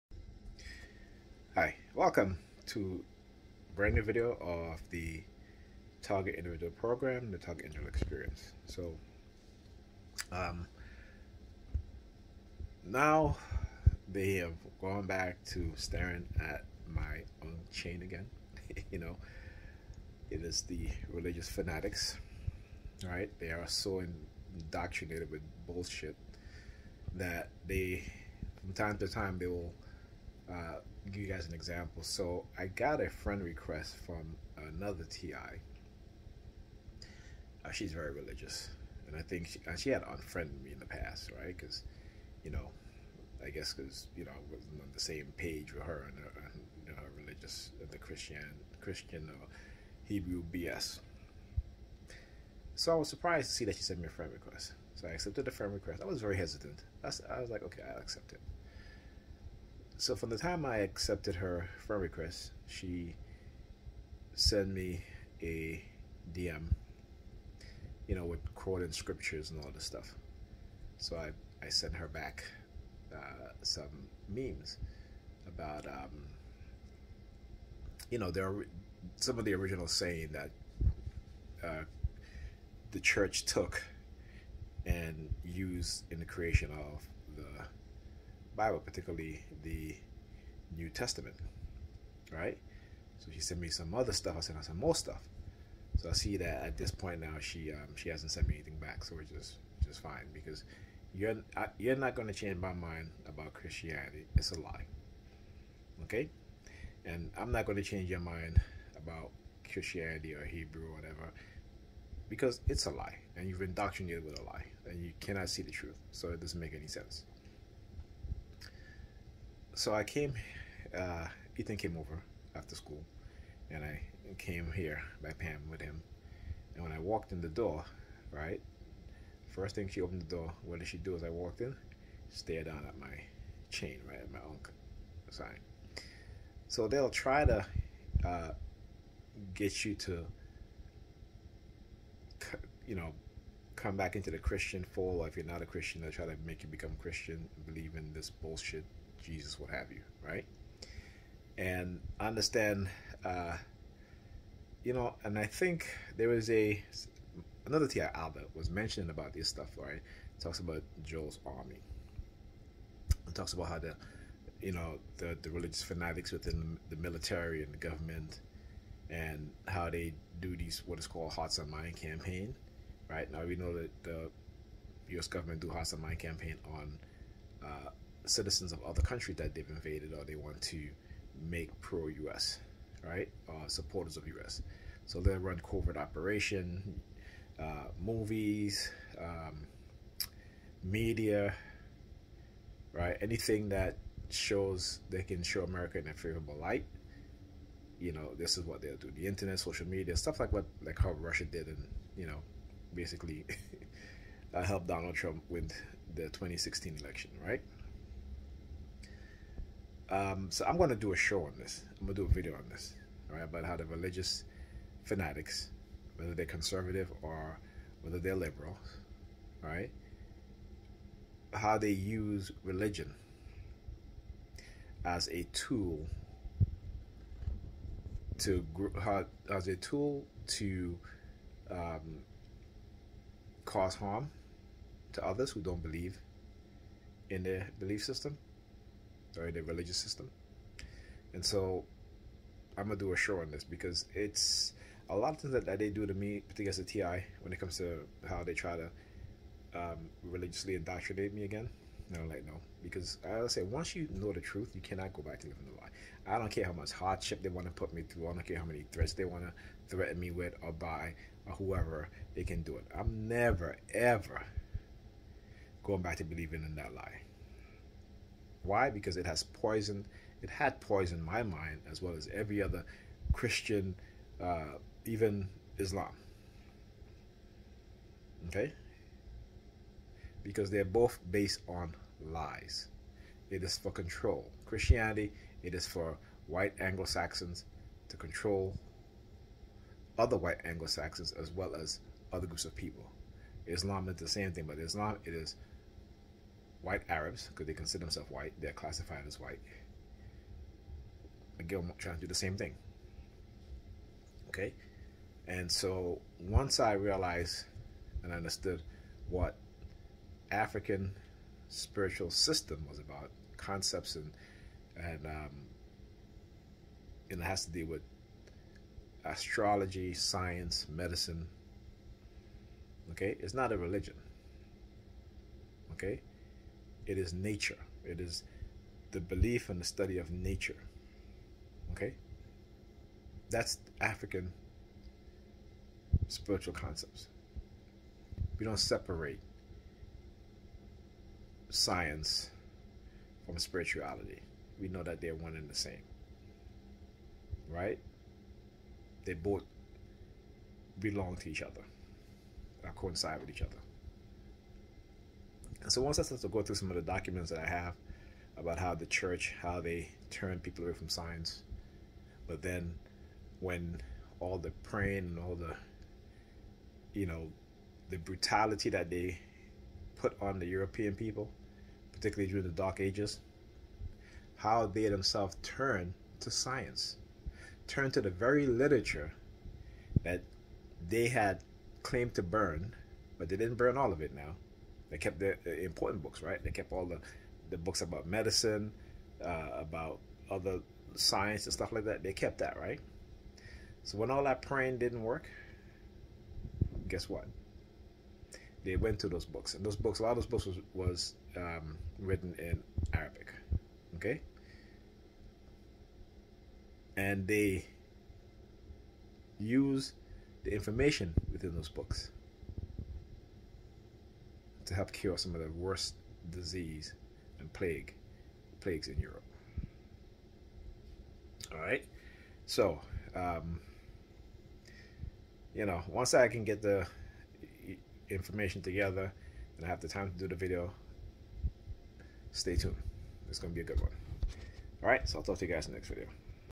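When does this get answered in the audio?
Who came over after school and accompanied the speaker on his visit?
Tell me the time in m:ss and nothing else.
2:01.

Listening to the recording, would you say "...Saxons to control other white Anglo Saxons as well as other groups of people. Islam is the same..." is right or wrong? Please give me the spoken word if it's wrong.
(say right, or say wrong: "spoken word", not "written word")
right.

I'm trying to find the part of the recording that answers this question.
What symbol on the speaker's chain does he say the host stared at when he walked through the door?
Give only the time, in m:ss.
2:14.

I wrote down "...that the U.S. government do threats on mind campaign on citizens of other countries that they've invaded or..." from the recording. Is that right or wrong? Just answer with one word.
wrong.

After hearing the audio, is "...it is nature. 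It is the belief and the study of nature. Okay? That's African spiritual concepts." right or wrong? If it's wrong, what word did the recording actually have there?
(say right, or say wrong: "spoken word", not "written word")
right.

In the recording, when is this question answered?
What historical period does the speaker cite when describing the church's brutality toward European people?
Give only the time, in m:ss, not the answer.
6:12.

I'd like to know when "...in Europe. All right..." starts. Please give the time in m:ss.
6:59.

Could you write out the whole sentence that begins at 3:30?
Um, so I'm going to do a show on this.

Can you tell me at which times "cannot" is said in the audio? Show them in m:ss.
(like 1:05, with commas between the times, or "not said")
1:55, 4:14.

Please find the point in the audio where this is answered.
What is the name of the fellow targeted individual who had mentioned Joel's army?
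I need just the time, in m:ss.
2:38.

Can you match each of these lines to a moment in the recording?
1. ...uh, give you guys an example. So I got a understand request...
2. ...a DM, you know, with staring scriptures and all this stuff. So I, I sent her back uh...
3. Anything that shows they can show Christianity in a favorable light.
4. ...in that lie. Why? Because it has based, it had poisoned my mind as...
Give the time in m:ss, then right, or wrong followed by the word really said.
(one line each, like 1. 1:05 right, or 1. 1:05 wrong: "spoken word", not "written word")
1. 0:30 wrong: "friend", not "understand"
2. 1:05 wrong: "quoting", not "staring"
3. 3:13 wrong: "America", not "Christianity"
4. 4:26 wrong: "poisoned", not "based".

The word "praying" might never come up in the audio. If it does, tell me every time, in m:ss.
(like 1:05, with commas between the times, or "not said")
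6:04, 6:34.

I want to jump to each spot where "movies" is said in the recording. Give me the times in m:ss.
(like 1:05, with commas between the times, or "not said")
3:08.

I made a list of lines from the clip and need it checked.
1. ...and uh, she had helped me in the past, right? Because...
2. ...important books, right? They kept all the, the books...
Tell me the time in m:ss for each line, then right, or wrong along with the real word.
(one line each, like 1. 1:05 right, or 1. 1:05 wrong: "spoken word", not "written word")
1. 0:39 wrong: "unfriended", not "helped"
2. 6:25 right.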